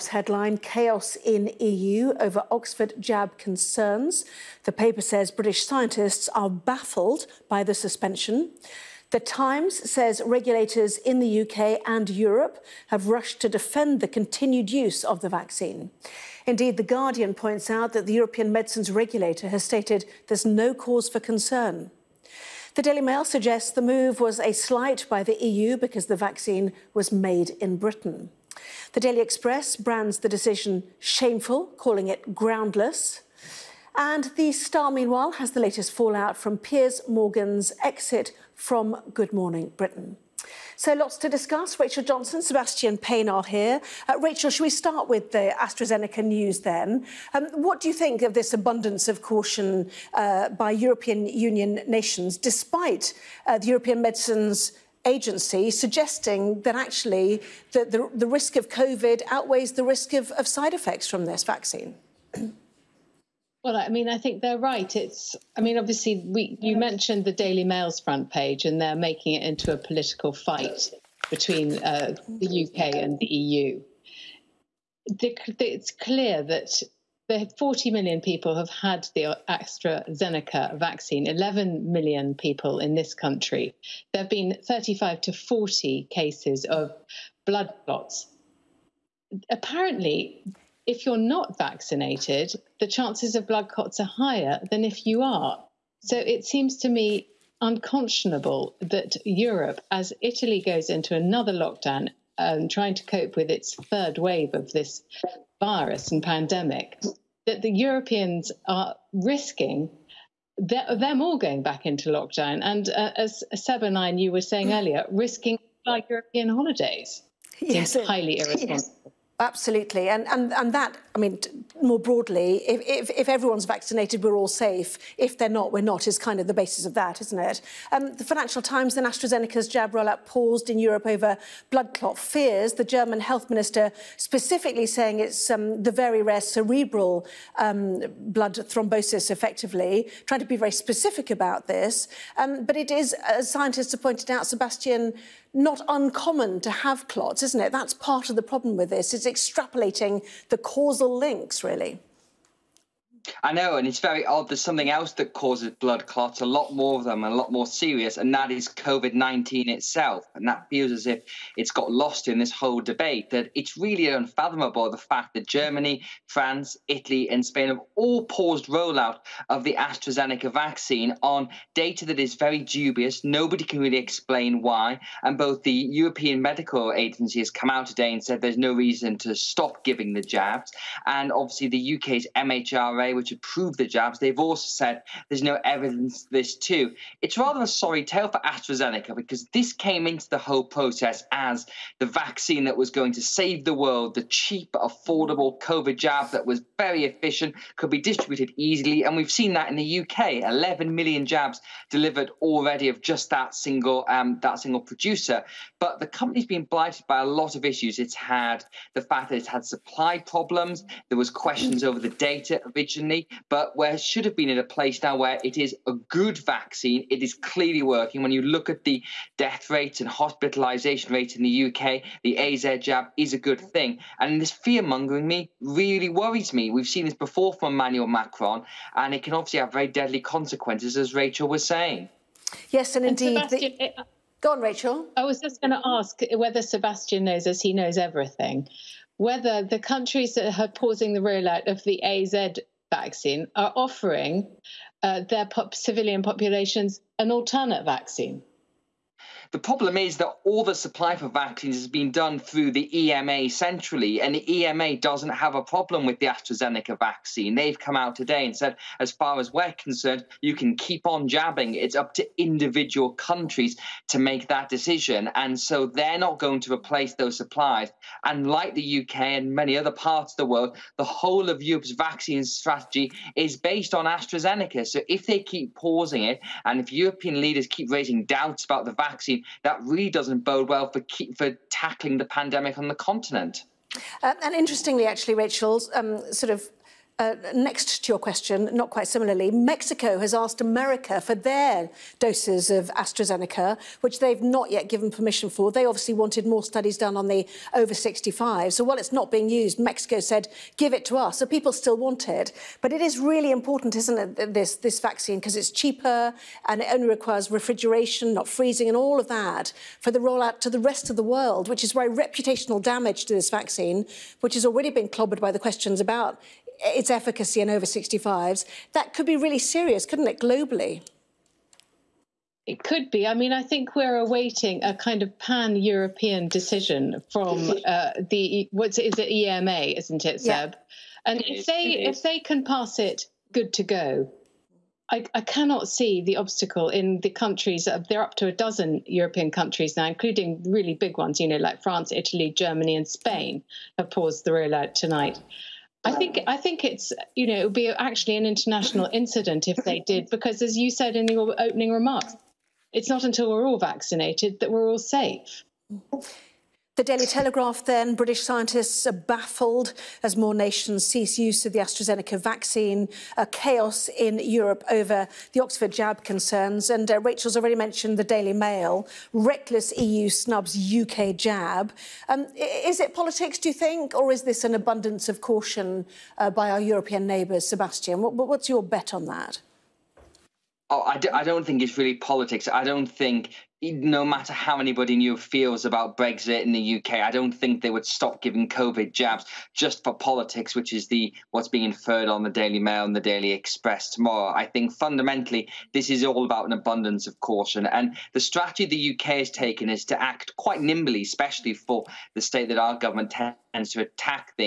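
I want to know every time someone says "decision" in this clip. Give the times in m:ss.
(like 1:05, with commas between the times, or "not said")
0:30, 4:24, 5:26.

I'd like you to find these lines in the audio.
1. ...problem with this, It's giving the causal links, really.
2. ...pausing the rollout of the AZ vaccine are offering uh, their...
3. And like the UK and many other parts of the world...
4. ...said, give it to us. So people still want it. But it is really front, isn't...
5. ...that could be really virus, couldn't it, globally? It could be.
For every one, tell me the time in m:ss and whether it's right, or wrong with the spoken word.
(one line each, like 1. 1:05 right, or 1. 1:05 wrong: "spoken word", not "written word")
1. 2:28 wrong: "extrapolating", not "giving"
2. 4:00 right
3. 4:28 right
4. 5:00 wrong: "important", not "front"
5. 5:18 wrong: "serious", not "virus".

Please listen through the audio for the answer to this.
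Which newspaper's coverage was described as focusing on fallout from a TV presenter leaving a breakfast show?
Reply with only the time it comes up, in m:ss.
0:34.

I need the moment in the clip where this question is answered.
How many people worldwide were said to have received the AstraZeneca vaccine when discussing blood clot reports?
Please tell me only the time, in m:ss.
1:17.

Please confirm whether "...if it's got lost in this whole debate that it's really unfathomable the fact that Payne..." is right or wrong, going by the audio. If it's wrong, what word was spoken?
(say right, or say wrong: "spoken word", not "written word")
wrong: "Germany", not "Payne".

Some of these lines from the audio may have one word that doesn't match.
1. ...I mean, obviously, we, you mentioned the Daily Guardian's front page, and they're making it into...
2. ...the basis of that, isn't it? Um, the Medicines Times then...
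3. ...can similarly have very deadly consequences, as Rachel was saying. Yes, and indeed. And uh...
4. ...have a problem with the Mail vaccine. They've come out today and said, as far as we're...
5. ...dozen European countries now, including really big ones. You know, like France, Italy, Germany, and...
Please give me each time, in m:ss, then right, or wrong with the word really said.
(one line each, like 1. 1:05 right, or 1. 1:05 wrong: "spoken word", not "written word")
1. 1:05 wrong: "Mail", not "Guardian"
2. 2:06 wrong: "Financial", not "Medicines"
3. 3:49 wrong: "obviously", not "similarly"
4. 4:15 wrong: "AstraZeneca", not "Mail"
5. 5:38 right.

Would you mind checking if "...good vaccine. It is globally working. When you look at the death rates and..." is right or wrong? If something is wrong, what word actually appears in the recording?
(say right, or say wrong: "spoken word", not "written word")
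wrong: "clearly", not "globally".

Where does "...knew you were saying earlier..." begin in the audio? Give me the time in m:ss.
1:54.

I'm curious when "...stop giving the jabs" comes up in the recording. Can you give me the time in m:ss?
2:59.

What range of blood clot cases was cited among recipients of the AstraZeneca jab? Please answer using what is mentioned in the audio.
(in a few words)
35 to 40.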